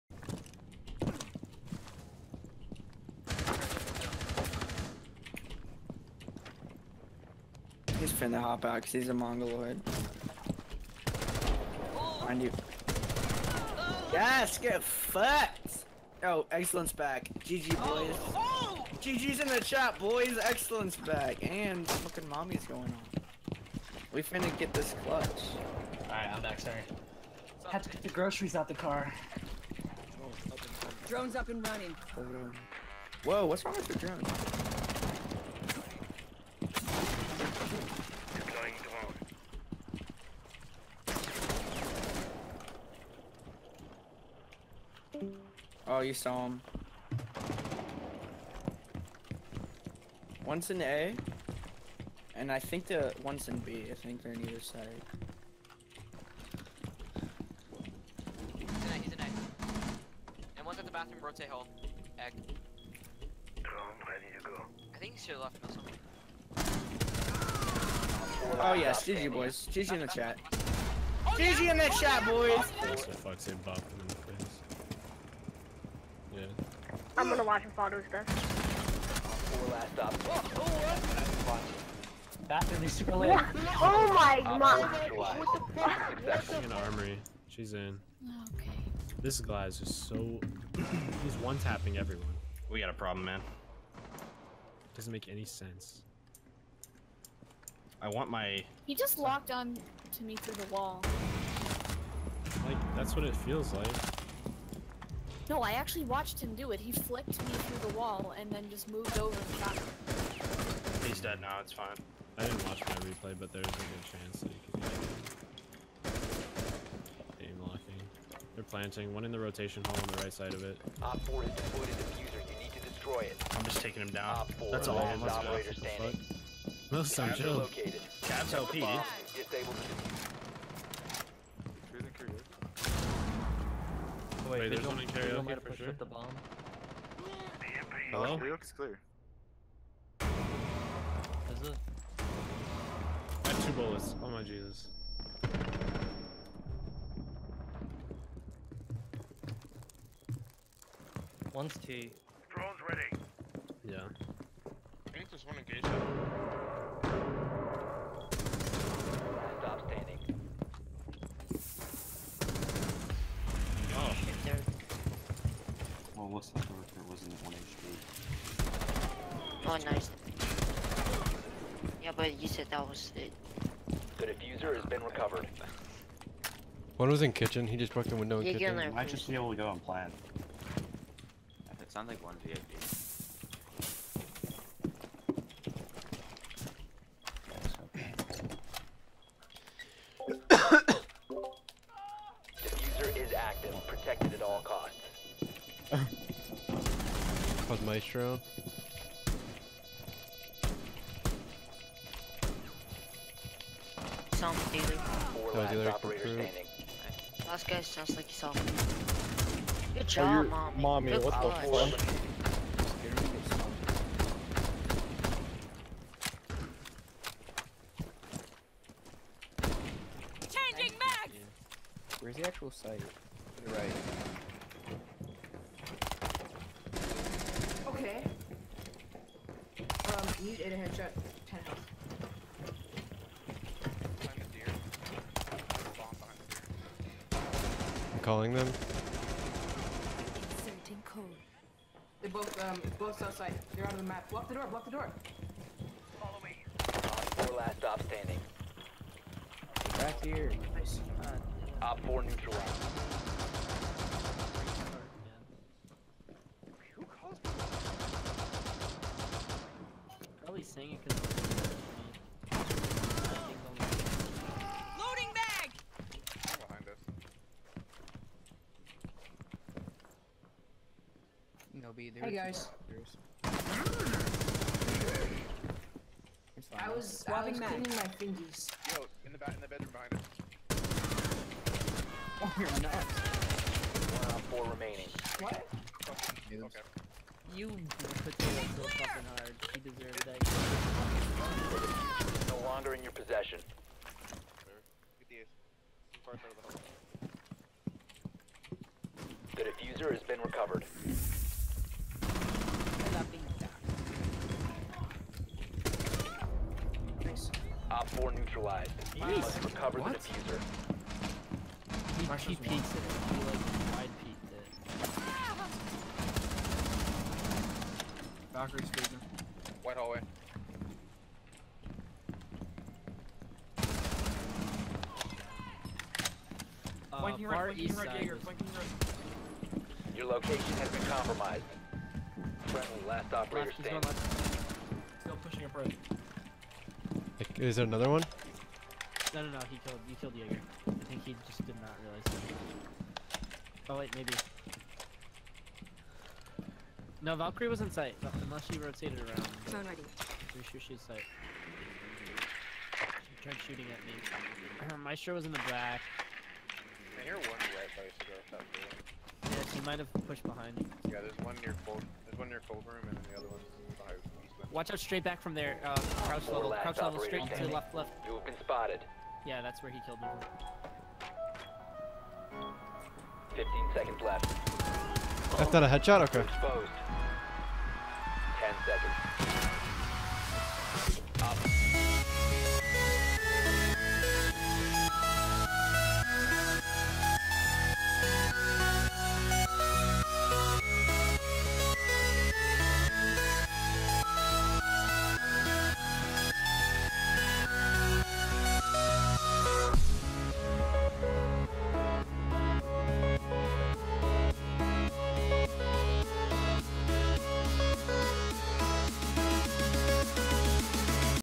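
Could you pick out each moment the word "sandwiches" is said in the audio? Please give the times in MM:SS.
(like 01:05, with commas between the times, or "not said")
not said.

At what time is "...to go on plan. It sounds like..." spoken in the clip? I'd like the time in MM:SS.
02:59.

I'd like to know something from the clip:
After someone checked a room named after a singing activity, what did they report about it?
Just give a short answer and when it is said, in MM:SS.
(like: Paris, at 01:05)
clear, at 02:18.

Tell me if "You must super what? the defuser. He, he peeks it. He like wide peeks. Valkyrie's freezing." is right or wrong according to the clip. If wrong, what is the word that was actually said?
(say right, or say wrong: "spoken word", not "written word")
wrong: "recover", not "super".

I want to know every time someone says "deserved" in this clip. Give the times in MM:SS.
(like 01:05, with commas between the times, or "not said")
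04:49.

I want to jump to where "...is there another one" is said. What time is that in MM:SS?
05:37.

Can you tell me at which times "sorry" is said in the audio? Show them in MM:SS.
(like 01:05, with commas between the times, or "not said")
00:26.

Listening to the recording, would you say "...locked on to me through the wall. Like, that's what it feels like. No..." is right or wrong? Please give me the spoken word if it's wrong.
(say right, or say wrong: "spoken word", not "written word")
right.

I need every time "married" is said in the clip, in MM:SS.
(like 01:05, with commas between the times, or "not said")
not said.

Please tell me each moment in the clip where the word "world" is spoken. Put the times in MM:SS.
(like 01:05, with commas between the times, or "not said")
not said.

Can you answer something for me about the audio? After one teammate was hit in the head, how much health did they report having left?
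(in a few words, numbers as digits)
10.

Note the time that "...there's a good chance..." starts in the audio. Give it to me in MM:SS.
01:53.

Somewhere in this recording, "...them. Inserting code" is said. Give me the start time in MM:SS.
03:58.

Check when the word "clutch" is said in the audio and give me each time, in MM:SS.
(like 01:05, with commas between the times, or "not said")
00:25, 03:31.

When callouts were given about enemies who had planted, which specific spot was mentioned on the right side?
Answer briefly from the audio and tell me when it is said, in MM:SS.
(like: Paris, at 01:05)
rotation hole, at 01:59.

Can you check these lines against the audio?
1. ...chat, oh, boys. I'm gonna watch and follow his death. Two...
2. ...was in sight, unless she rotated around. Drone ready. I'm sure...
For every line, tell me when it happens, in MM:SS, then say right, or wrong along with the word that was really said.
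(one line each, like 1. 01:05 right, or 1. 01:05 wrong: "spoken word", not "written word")
1. 01:12 wrong: "Four", not "Two"
2. 05:47 right.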